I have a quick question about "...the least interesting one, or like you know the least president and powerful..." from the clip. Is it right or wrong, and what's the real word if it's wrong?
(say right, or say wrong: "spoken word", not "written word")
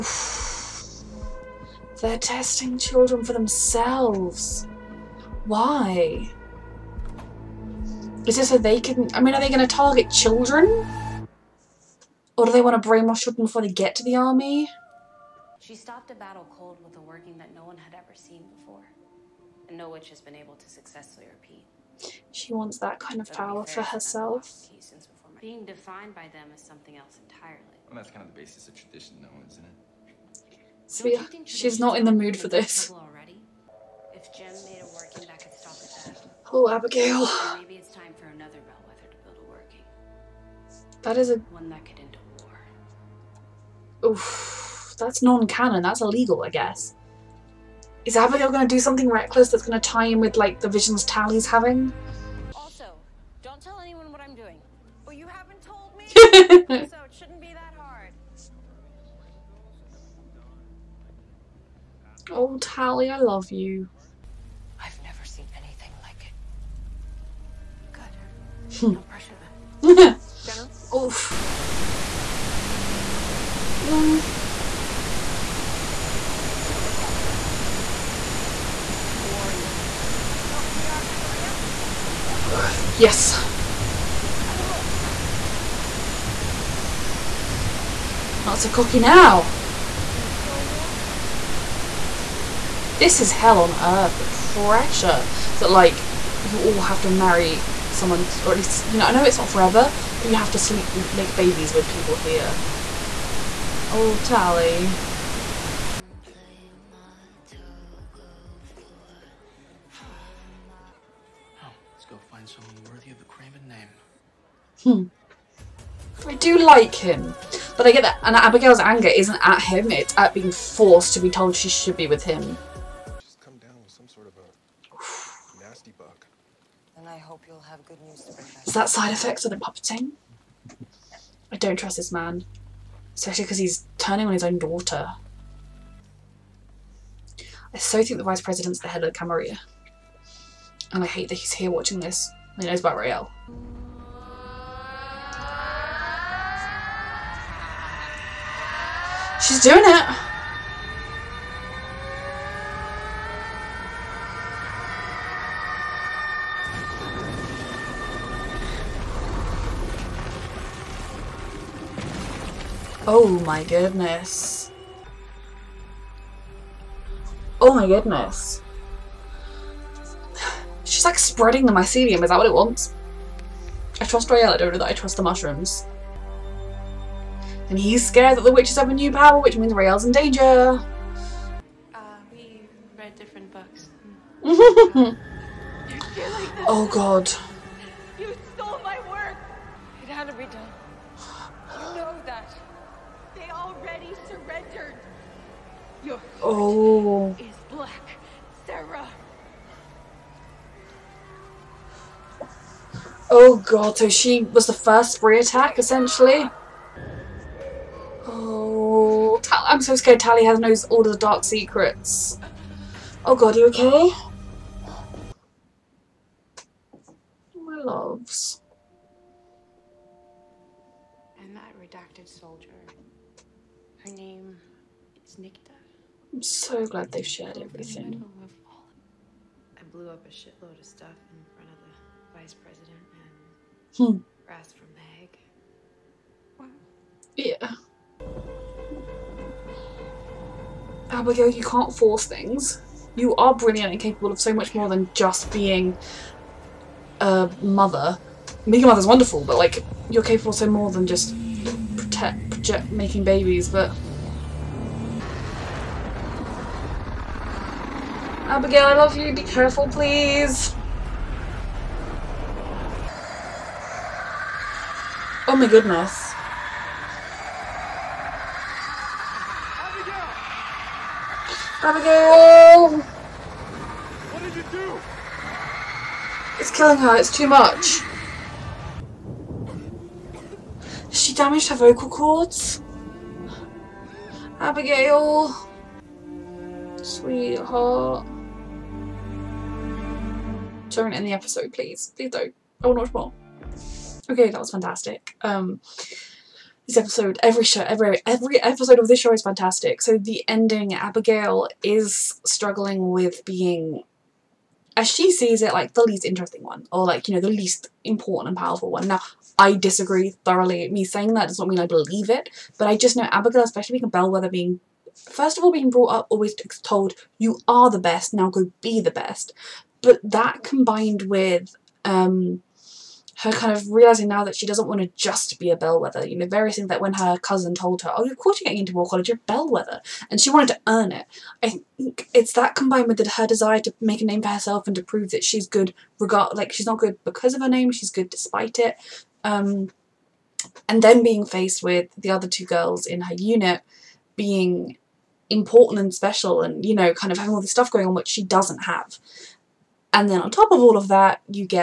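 wrong: "important", not "president".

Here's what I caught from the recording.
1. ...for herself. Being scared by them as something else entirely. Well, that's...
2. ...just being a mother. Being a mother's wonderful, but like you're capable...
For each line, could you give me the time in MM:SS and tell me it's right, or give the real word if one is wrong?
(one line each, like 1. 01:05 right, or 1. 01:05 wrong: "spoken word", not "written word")
1. 00:23 wrong: "defined", not "scared"
2. 04:05 right.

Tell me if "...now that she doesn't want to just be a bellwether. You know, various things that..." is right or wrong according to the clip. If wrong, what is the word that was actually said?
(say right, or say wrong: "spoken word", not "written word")
right.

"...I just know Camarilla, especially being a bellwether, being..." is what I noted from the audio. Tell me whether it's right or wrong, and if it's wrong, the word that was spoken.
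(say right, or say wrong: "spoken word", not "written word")
wrong: "Abigail", not "Camarilla".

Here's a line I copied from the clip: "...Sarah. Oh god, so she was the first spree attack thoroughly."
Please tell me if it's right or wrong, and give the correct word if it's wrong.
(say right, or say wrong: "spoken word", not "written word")
wrong: "essentially", not "thoroughly".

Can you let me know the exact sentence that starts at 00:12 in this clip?
Or do they want to brainwash children before they get to the army?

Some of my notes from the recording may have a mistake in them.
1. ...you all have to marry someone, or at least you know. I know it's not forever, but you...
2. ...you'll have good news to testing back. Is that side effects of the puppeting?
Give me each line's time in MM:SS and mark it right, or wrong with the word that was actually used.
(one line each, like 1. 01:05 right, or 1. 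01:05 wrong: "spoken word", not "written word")
1. 01:36 right
2. 02:07 wrong: "bring", not "testing".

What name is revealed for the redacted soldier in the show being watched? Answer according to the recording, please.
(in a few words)
Nikita.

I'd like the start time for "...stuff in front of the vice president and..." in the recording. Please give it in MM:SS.
03:50.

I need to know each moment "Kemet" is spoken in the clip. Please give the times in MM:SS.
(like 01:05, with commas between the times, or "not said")
not said.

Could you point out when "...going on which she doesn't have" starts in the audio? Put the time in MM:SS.
05:47.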